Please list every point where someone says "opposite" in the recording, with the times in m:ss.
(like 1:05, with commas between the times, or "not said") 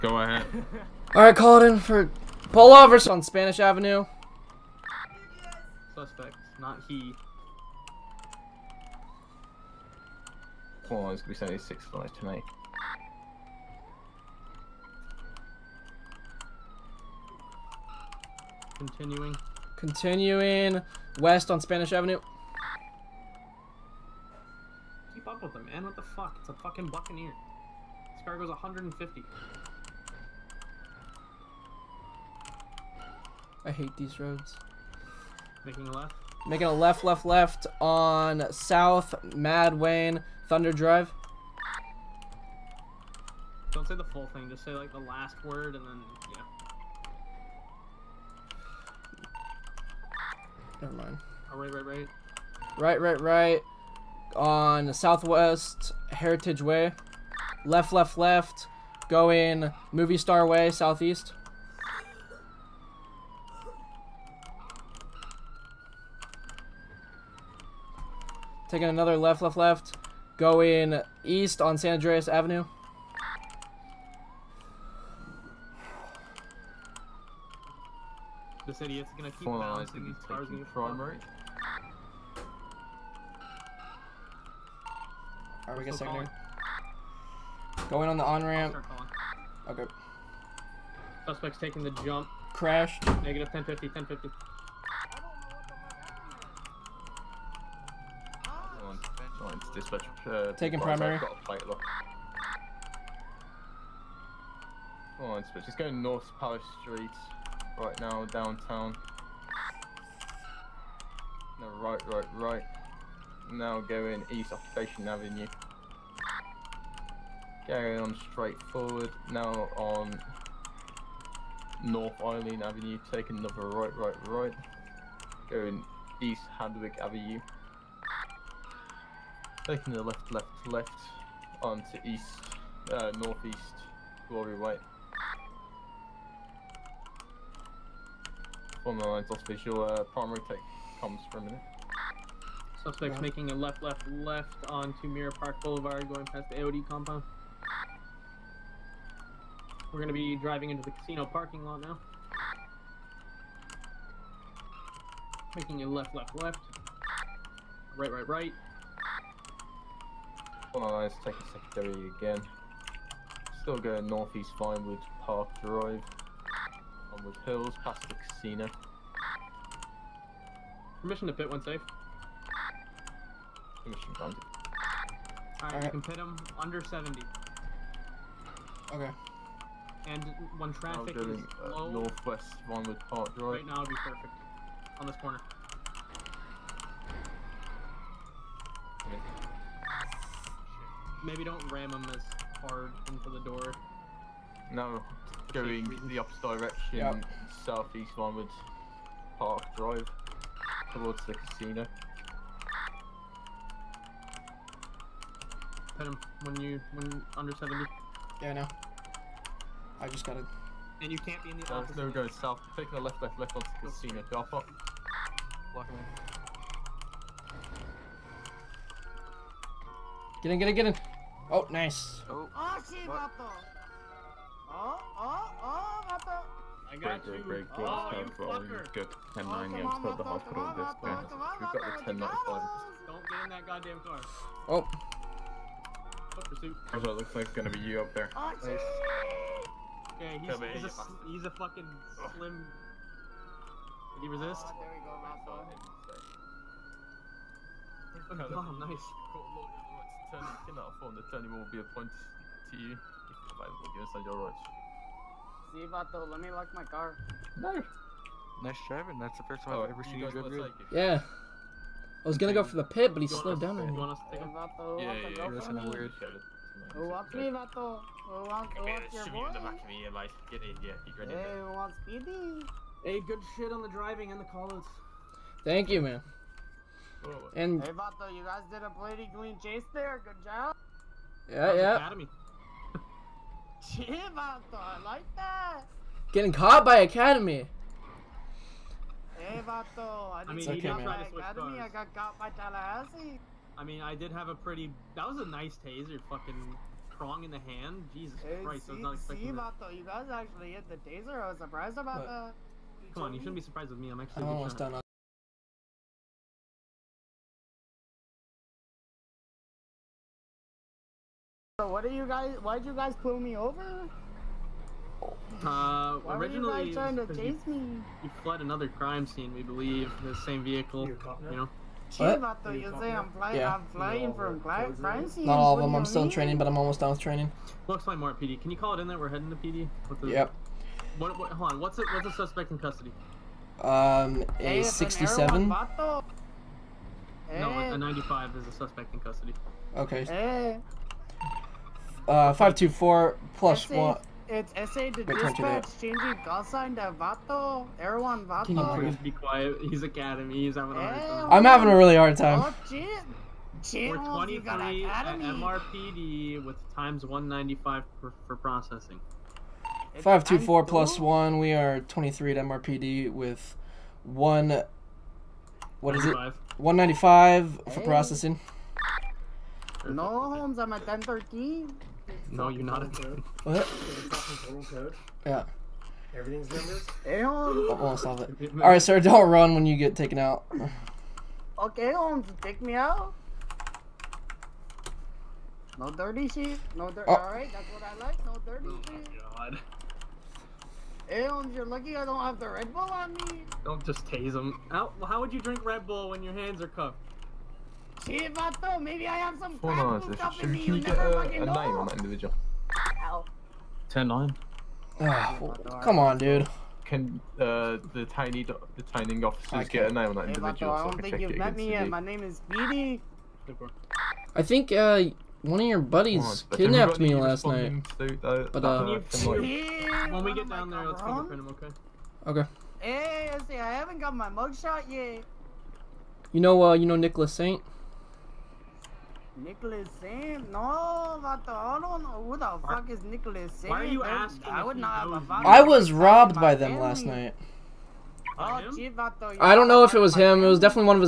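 3:16.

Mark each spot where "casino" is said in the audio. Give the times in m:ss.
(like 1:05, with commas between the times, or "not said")
2:30, 2:48, 3:21, 3:33.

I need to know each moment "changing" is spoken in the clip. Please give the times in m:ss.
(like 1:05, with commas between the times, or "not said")
5:45.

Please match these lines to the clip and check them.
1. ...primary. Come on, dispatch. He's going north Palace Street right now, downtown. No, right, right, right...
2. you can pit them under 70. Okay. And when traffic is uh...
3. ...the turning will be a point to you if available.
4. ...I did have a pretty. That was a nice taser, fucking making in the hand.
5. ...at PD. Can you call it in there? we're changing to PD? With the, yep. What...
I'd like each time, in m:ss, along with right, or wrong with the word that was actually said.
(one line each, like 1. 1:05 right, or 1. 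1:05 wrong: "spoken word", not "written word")
1. 1:40 right
2. 2:55 right
3. 4:11 right
4. 4:53 wrong: "prong", not "making"
5. 5:28 wrong: "heading", not "changing".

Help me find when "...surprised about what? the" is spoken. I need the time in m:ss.
5:01.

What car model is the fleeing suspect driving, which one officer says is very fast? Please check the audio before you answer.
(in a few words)
Buccaneer.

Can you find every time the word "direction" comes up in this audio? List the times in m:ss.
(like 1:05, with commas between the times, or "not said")
3:16.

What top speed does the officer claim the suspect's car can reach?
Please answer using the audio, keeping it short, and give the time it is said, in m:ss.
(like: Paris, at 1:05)
150, at 0:28.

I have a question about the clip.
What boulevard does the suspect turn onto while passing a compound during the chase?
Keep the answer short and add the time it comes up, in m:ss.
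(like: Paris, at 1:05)
Mirror Park Boulevard, at 2:25.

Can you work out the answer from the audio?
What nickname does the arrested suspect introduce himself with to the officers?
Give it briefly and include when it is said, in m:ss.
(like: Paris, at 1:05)
Speedy, at 6:52.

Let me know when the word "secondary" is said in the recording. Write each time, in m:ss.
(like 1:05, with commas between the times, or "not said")
1:25, 2:41.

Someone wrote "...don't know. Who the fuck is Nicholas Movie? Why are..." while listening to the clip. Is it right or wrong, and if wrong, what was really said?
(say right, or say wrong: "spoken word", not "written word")
wrong: "Sam", not "Movie".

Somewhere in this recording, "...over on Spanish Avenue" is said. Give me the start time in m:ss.
0:02.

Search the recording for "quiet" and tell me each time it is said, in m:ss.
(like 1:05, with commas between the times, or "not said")
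5:49.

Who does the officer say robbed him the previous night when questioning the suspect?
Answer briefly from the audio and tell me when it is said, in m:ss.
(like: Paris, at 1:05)
Nicholas Saint, at 7:07.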